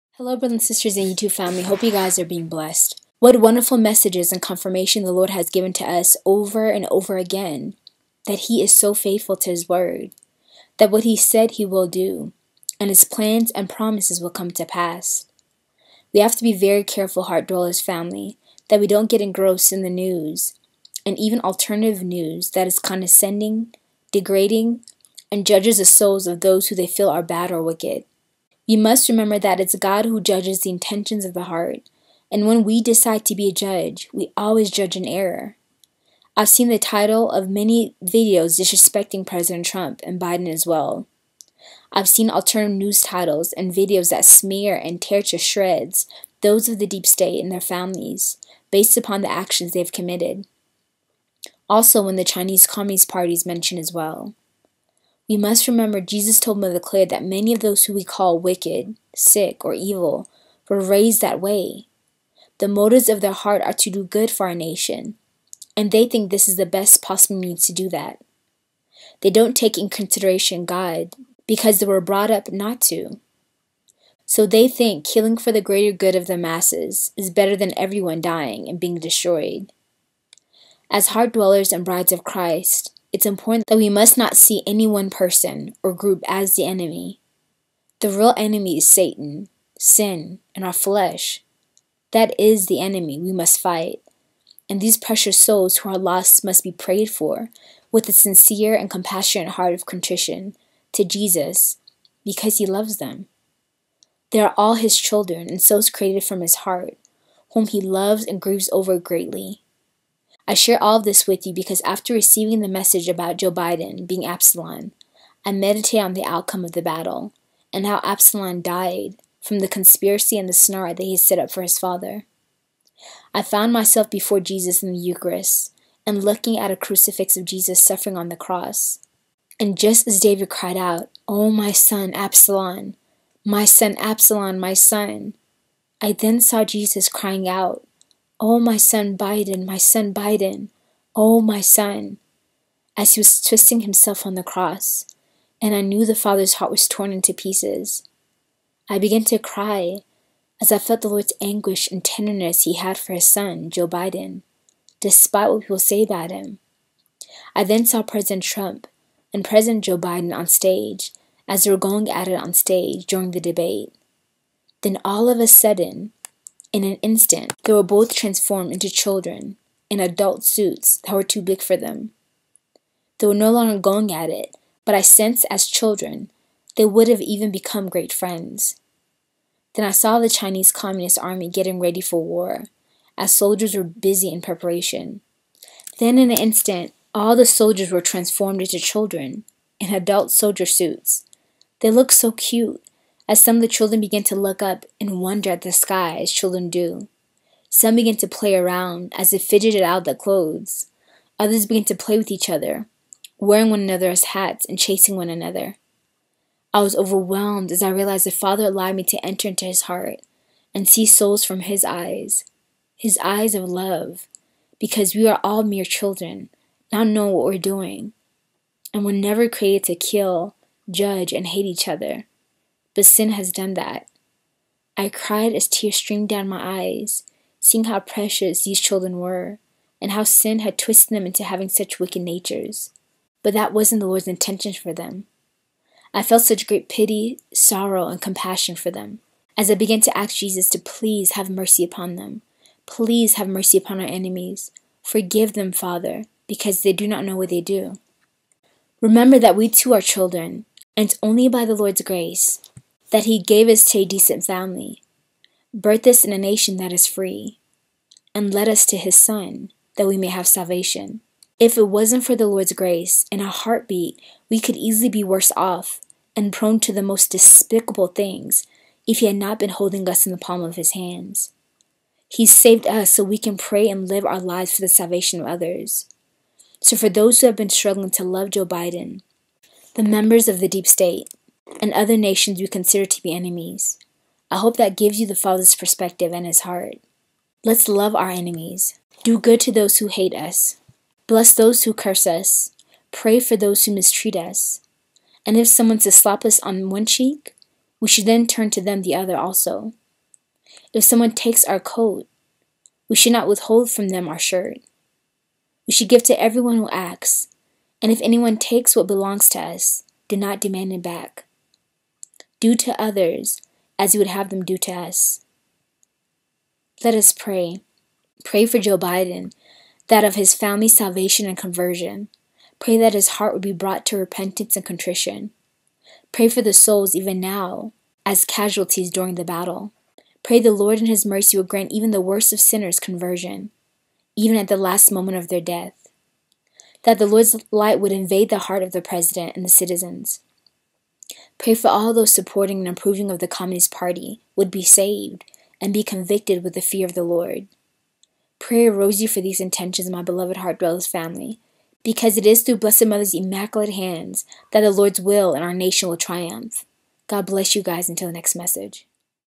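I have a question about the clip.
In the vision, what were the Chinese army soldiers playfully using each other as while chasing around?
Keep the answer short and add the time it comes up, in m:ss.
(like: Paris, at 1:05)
hats, at 3:24.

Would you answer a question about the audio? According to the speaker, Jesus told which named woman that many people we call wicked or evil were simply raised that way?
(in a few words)
Mother Clare.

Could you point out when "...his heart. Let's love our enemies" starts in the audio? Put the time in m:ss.
4:46.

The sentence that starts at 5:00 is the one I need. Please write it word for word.
If someone takes our coat, we should not withhold from them our shirt.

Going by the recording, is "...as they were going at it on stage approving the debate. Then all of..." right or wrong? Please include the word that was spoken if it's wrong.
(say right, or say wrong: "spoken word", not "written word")
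wrong: "during", not "approving".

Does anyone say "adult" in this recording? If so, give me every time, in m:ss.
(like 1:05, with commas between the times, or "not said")
2:49, 3:09.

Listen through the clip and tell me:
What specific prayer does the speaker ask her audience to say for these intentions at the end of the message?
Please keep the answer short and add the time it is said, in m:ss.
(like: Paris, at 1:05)
a rosary, at 5:48.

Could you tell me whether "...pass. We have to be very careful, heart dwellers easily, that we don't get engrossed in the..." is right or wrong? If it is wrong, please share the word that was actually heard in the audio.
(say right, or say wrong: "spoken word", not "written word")
wrong: "family", not "easily".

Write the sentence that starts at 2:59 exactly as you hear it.
Then I saw the Chinese Communist Army getting ready for war, as soldiers were busy in preparation.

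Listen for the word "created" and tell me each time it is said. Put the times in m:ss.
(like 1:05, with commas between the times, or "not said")
1:45, 3:39.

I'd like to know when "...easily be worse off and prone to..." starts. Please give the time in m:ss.
4:24.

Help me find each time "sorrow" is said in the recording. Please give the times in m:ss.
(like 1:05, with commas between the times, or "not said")
3:57.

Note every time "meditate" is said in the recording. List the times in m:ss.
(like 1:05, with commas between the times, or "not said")
1:55.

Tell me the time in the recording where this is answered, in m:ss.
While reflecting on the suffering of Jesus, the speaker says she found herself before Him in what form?
2:04.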